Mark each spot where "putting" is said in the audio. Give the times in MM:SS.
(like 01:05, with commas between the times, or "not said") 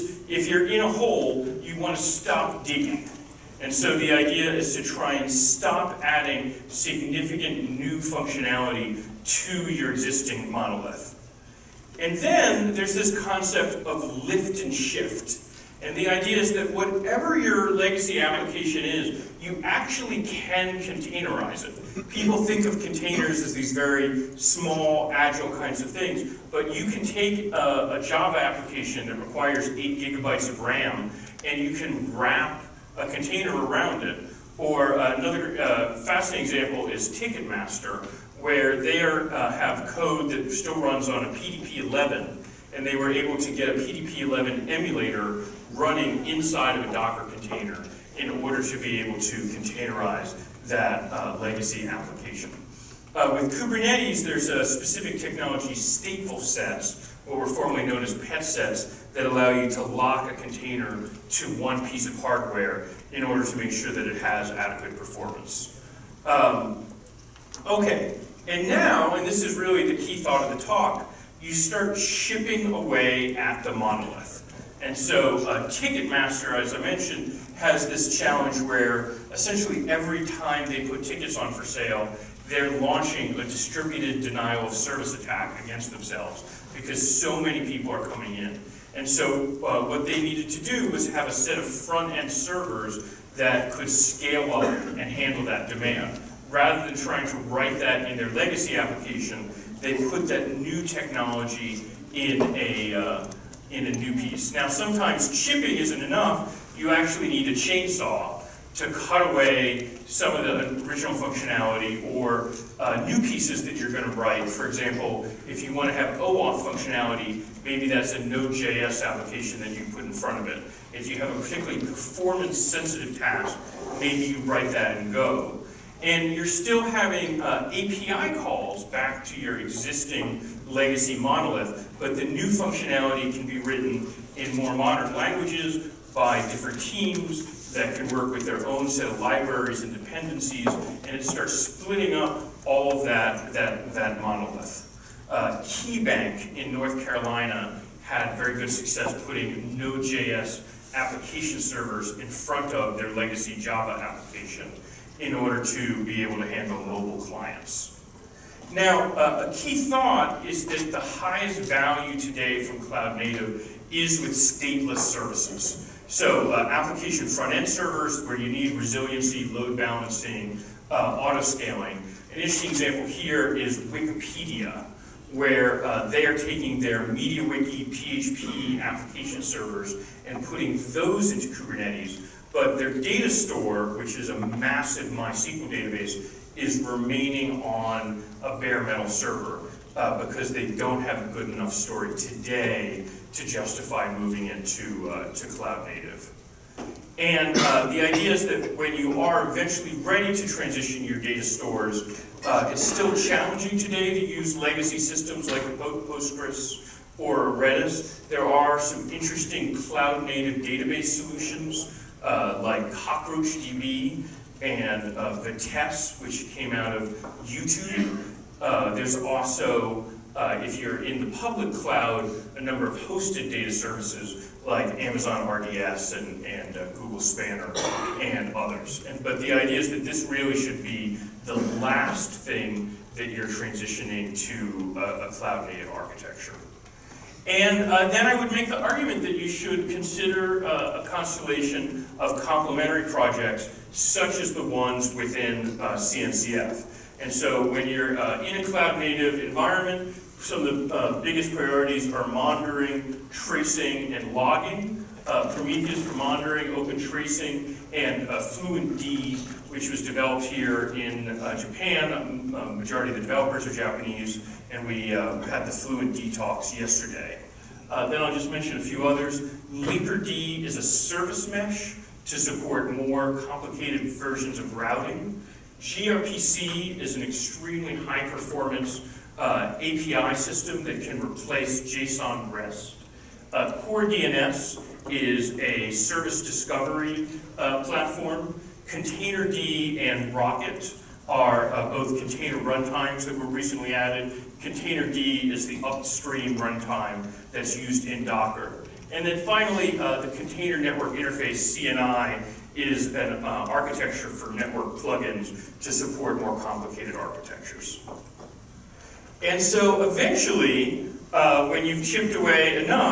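02:29, 03:00.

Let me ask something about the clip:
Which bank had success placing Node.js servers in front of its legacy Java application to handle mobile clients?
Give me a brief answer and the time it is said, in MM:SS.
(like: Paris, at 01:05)
KeyBank, at 02:25.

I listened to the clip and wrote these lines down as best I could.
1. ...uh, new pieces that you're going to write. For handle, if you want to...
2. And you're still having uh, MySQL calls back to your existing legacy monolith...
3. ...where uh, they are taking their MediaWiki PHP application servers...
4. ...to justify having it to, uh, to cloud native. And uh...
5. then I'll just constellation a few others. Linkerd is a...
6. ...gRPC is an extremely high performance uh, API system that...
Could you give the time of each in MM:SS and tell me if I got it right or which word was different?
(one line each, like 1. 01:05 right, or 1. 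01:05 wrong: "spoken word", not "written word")
1. 01:52 wrong: "example", not "handle"
2. 02:06 wrong: "API", not "MySQL"
3. 02:55 right
4. 03:13 wrong: "moving", not "having"
5. 04:27 wrong: "mention", not "constellation"
6. 04:35 right.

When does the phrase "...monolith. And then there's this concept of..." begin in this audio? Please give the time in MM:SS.
00:10.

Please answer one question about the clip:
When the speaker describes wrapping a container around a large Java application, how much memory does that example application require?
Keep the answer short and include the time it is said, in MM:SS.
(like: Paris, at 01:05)
8 gigabytes, at 00:29.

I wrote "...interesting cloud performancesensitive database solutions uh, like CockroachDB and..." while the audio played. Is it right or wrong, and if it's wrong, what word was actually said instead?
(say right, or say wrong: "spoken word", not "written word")
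wrong: "native", not "performancesensitive".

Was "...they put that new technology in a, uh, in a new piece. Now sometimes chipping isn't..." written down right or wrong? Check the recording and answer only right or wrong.
right.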